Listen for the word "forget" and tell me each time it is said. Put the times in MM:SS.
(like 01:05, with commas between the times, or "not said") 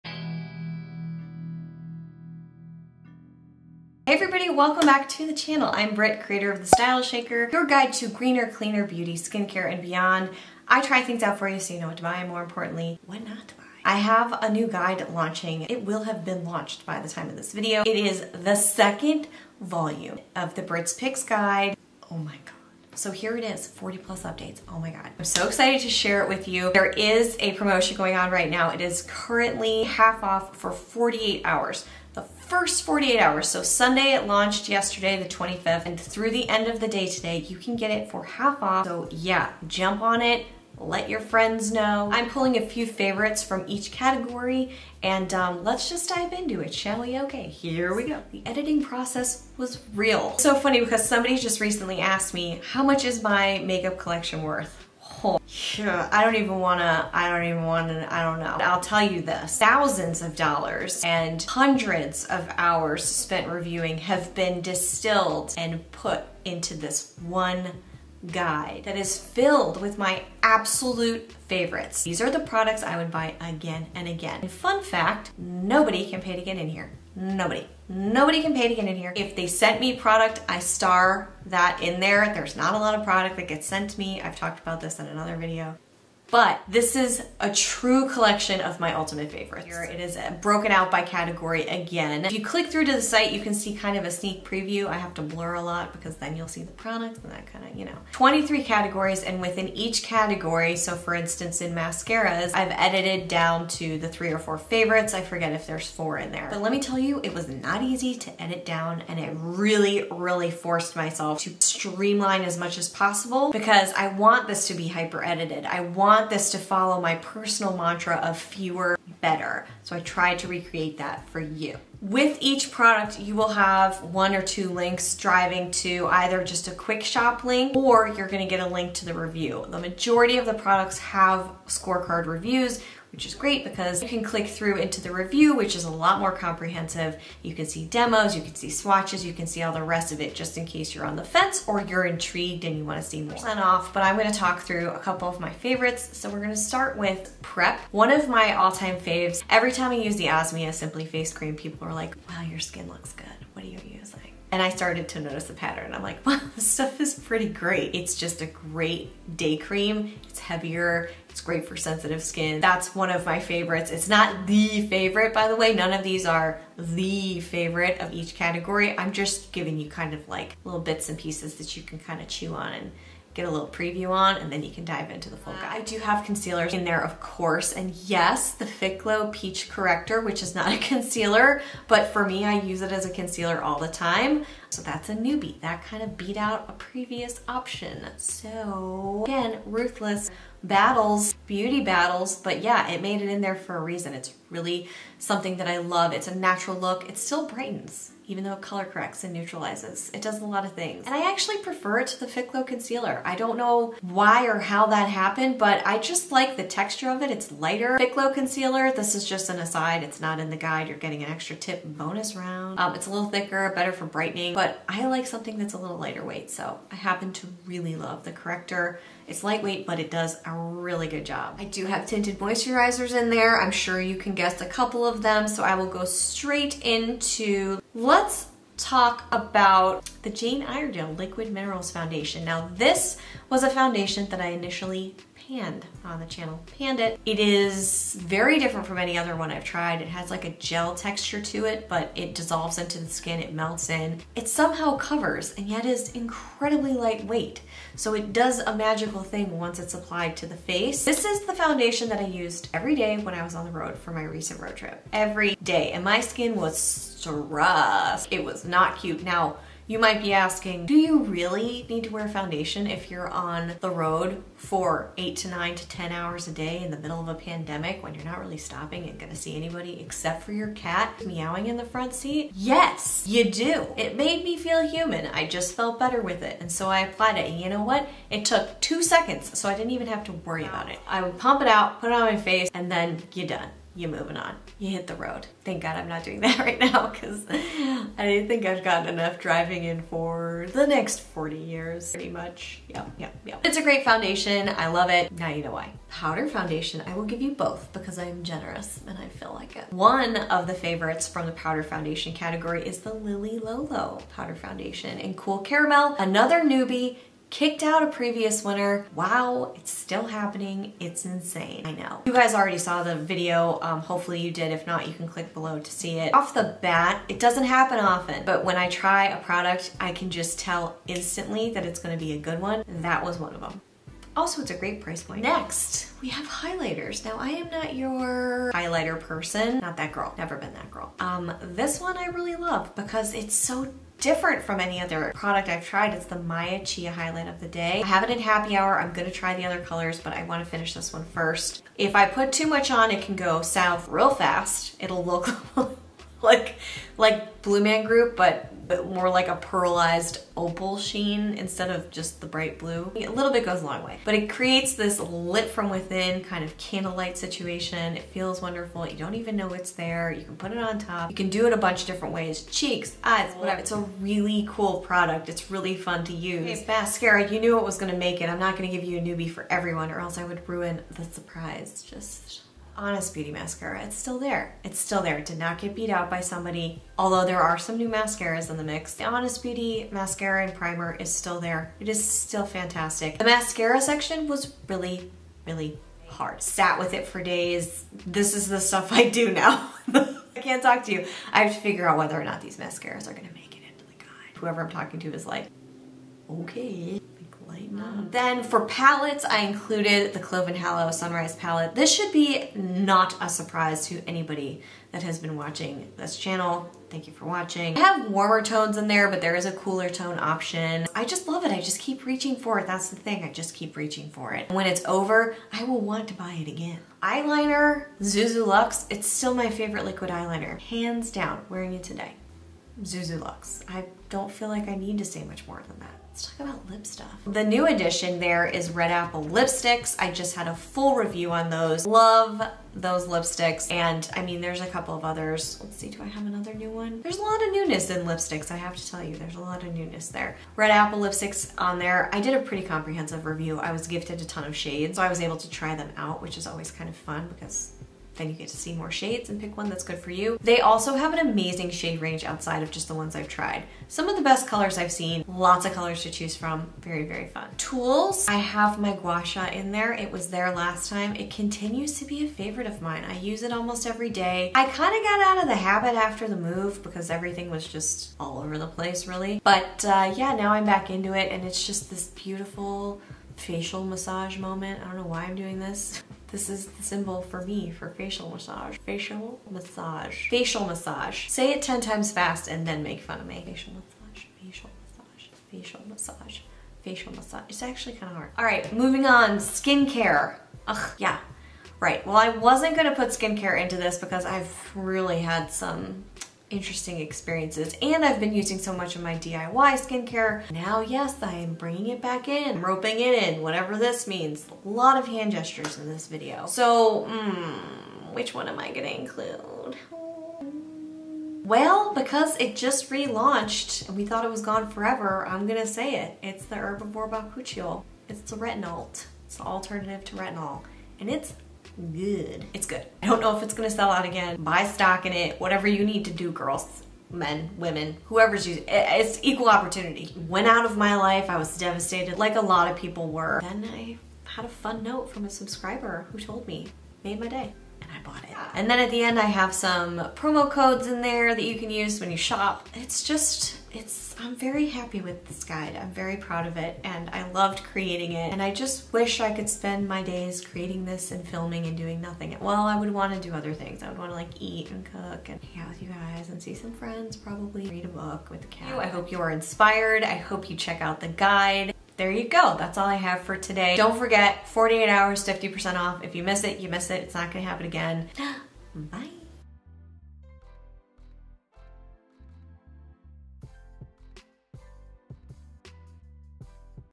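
01:45, 09:24.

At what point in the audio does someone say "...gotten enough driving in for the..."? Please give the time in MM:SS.
04:48.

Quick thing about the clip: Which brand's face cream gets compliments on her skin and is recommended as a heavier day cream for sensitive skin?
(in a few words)
Osmia.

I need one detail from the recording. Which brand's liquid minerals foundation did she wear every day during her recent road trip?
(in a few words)
Jane Iredale.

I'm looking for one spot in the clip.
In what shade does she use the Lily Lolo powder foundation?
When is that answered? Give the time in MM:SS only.
05:05.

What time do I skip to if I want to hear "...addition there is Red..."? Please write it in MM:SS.
07:07.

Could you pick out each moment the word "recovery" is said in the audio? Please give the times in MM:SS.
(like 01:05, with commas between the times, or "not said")
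not said.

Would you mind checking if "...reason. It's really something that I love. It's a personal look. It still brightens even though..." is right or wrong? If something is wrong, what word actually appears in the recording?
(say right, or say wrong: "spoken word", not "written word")
wrong: "natural", not "personal".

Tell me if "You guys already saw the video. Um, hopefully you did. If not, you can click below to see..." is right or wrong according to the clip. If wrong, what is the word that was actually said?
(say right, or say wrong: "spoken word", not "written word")
right.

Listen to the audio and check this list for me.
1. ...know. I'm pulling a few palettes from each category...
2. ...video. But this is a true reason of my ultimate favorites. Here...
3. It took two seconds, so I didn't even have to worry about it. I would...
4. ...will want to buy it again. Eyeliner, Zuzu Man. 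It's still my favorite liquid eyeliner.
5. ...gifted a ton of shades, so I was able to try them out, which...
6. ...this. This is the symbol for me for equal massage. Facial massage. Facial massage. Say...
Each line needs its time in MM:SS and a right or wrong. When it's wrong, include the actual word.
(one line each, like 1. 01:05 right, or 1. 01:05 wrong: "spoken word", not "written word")
1. 00:41 wrong: "favorites", not "palettes"
2. 01:25 wrong: "collection", not "reason"
3. 04:38 right
4. 06:55 wrong: "Luxe", not "Man"
5. 07:24 right
6. 07:55 wrong: "facial", not "equal".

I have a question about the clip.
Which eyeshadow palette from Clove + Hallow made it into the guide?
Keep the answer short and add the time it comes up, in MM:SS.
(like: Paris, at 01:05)
Sunrise, at 06:41.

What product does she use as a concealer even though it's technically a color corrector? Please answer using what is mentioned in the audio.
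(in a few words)
Fitglow Peach Corrector.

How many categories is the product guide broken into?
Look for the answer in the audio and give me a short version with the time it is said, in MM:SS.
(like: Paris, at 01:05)
23, at 01:38.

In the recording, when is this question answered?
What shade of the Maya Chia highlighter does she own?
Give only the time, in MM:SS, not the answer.
05:38.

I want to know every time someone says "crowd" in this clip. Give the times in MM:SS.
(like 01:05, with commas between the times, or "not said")
not said.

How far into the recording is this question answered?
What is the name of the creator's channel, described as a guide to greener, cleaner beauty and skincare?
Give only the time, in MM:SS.
00:06.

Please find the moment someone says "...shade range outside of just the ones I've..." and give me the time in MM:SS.
07:31.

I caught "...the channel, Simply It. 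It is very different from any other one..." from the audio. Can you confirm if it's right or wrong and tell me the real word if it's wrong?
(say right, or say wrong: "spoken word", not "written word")
wrong: "Panned", not "Simply".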